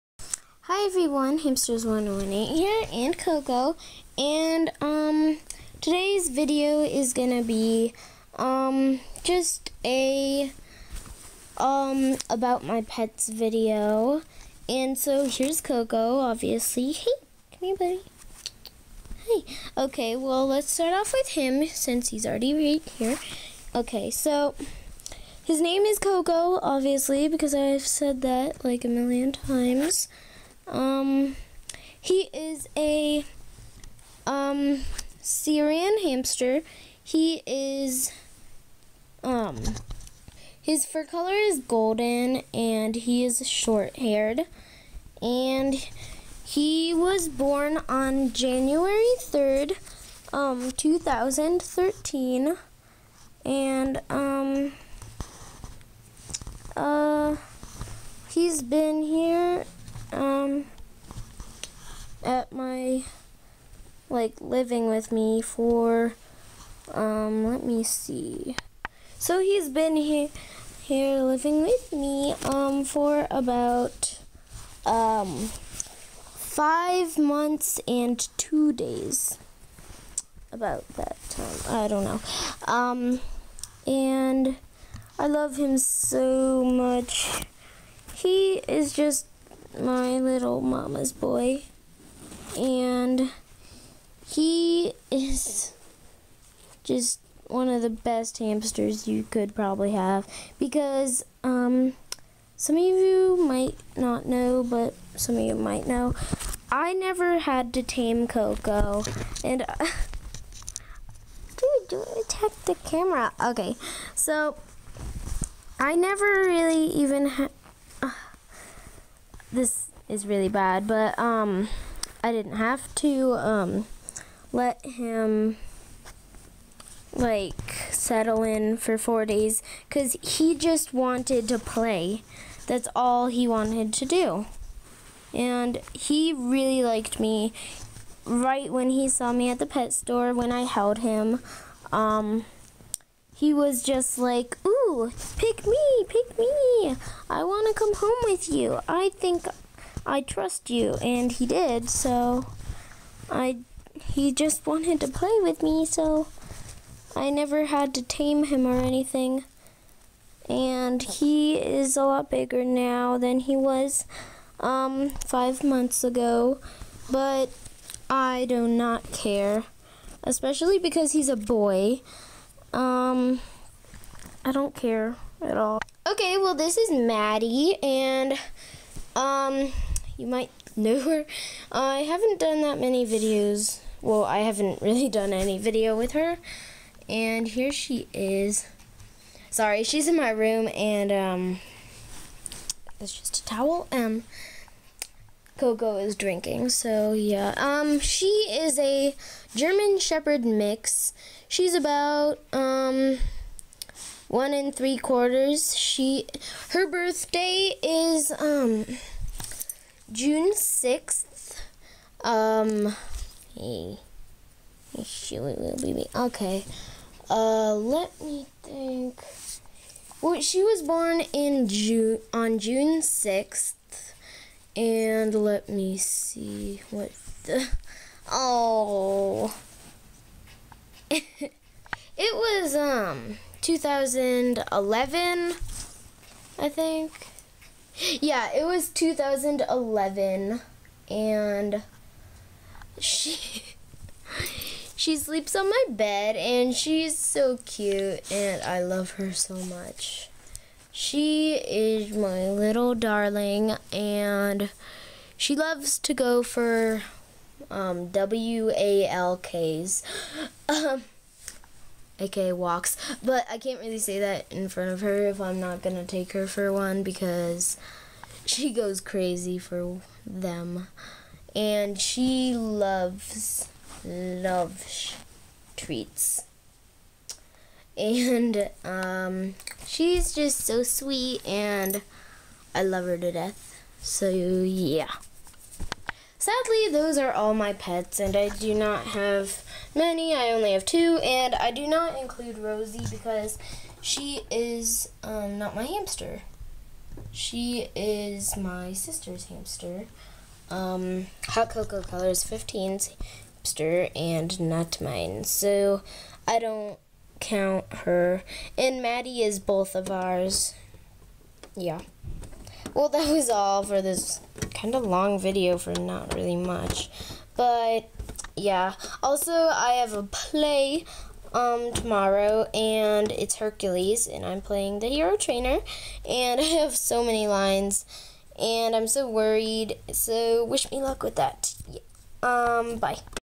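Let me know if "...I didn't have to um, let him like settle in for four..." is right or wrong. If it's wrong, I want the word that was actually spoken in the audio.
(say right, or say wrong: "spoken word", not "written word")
right.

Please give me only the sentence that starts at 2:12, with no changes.
That's all he wanted to do.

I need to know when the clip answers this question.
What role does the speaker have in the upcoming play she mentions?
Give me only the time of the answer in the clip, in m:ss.
5:25.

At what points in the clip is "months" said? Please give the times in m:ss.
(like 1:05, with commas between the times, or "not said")
1:17, 2:45.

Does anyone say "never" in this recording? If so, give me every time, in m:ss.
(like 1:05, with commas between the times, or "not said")
1:46, 1:55, 2:37.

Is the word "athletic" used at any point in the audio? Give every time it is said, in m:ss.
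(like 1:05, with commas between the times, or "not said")
not said.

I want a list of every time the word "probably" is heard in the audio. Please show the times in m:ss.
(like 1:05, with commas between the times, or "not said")
1:39.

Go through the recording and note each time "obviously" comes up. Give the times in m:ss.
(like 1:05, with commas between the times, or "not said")
0:16, 0:26.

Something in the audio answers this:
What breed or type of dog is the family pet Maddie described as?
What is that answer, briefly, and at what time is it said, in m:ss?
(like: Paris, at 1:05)
German Shepherd mix, at 3:19.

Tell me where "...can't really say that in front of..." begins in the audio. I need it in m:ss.
4:23.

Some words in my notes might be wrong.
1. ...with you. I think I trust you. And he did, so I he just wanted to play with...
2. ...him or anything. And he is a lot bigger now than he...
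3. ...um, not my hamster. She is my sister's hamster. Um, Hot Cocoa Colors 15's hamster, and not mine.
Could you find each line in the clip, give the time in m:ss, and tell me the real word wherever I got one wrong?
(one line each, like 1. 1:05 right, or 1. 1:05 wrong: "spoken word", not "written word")
1. 2:28 right
2. 2:38 right
3. 4:55 right.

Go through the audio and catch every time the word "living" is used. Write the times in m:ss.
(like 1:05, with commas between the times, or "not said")
1:04, 1:11.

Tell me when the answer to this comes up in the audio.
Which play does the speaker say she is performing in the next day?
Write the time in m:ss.
5:23.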